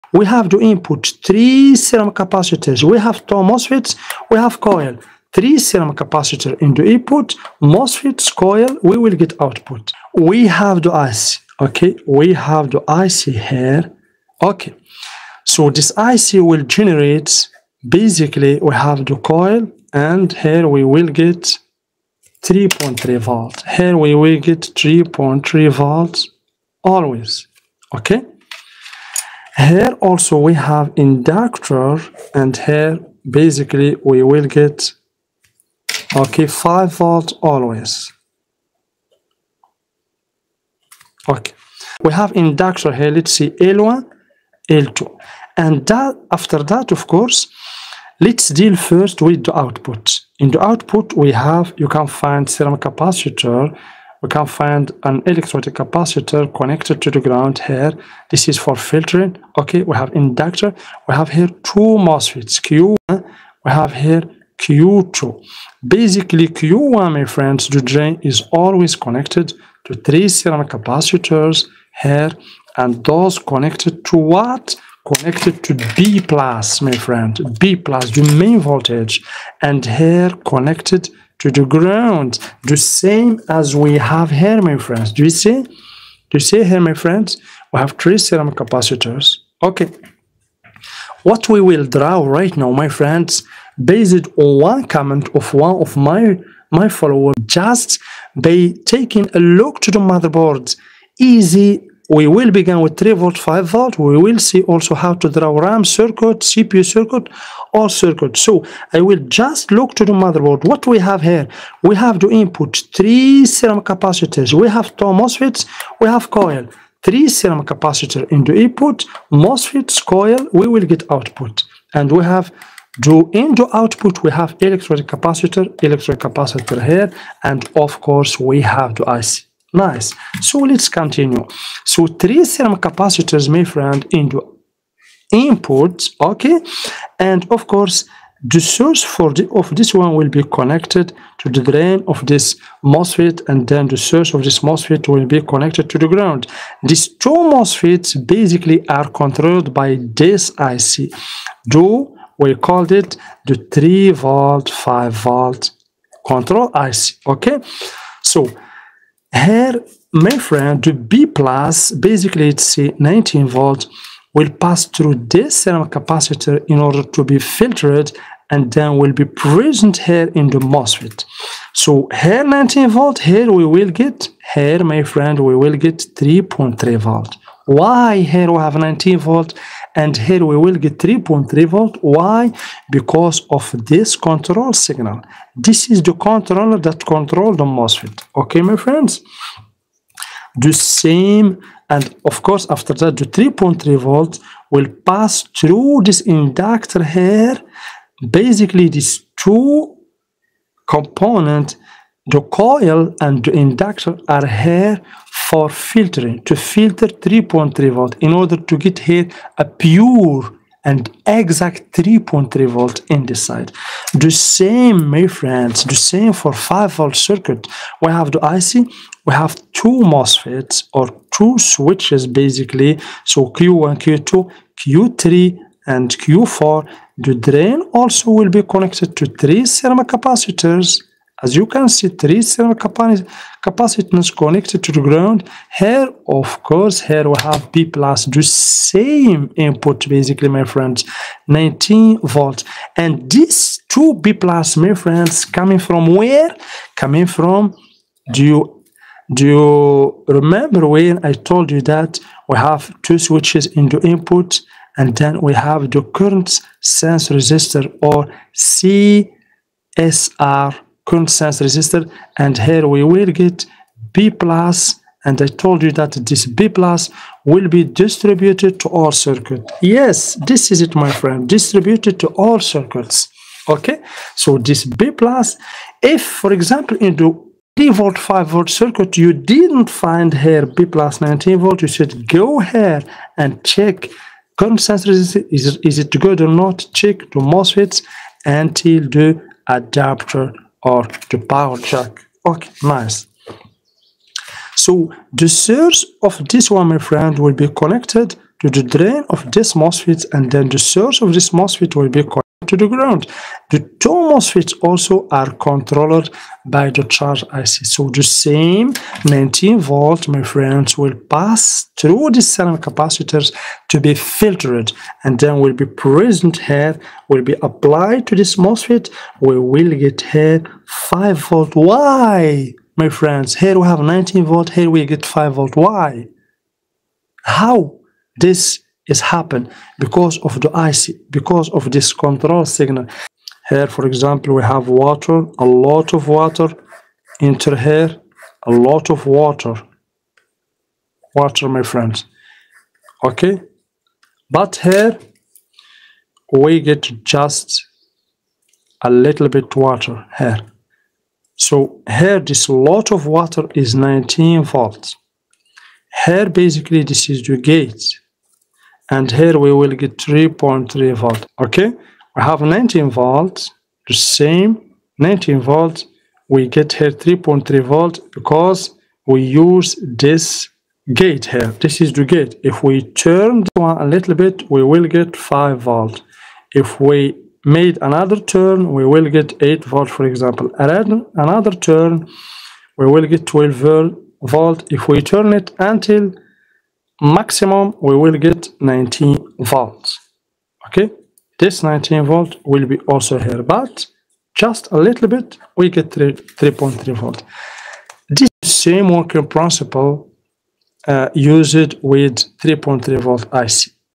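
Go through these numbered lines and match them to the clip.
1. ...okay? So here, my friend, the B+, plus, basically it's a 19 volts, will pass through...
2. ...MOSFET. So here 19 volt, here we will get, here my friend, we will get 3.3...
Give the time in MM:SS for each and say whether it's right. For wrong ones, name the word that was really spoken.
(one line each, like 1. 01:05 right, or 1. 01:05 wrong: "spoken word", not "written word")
1. 02:37 right
2. 02:50 right.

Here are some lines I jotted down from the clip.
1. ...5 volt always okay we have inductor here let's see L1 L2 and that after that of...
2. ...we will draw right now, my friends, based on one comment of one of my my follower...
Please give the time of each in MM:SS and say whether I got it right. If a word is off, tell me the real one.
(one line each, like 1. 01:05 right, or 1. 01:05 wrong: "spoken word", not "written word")
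1. 00:36 right
2. 01:31 right.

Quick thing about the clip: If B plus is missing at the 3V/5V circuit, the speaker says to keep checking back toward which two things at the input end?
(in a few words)
the adapter or the power jack.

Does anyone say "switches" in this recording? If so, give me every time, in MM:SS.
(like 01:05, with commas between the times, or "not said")
03:41, 04:13.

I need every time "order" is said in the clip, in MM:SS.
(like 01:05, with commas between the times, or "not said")
02:46, 03:28.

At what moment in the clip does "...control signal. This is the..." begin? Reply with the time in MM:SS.
03:04.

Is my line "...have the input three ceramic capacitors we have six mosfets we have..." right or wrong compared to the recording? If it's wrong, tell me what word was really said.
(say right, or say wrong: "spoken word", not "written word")
wrong: "two", not "six".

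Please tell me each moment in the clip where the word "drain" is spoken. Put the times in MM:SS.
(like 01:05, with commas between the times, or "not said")
01:07, 02:21, 03:47, 04:58.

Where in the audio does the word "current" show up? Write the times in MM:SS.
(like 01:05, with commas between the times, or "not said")
04:16, 04:21, 04:44.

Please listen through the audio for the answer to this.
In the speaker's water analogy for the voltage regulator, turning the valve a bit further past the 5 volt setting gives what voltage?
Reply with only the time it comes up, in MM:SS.
06:19.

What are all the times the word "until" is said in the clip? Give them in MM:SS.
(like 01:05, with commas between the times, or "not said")
04:48, 06:25.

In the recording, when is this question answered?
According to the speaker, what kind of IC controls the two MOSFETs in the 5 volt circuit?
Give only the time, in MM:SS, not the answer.
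05:07.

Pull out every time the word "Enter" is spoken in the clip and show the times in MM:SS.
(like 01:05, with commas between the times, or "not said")
05:37.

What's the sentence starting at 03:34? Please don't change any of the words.
The same, my friends, the same for 5 volt circuit.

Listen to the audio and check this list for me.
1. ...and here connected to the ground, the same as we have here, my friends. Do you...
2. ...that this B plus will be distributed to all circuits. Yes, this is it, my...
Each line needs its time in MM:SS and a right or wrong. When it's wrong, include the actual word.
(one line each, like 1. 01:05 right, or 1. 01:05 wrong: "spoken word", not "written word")
1. 01:19 right
2. 04:25 right.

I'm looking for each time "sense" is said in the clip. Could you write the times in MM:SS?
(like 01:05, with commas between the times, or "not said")
04:16, 04:21.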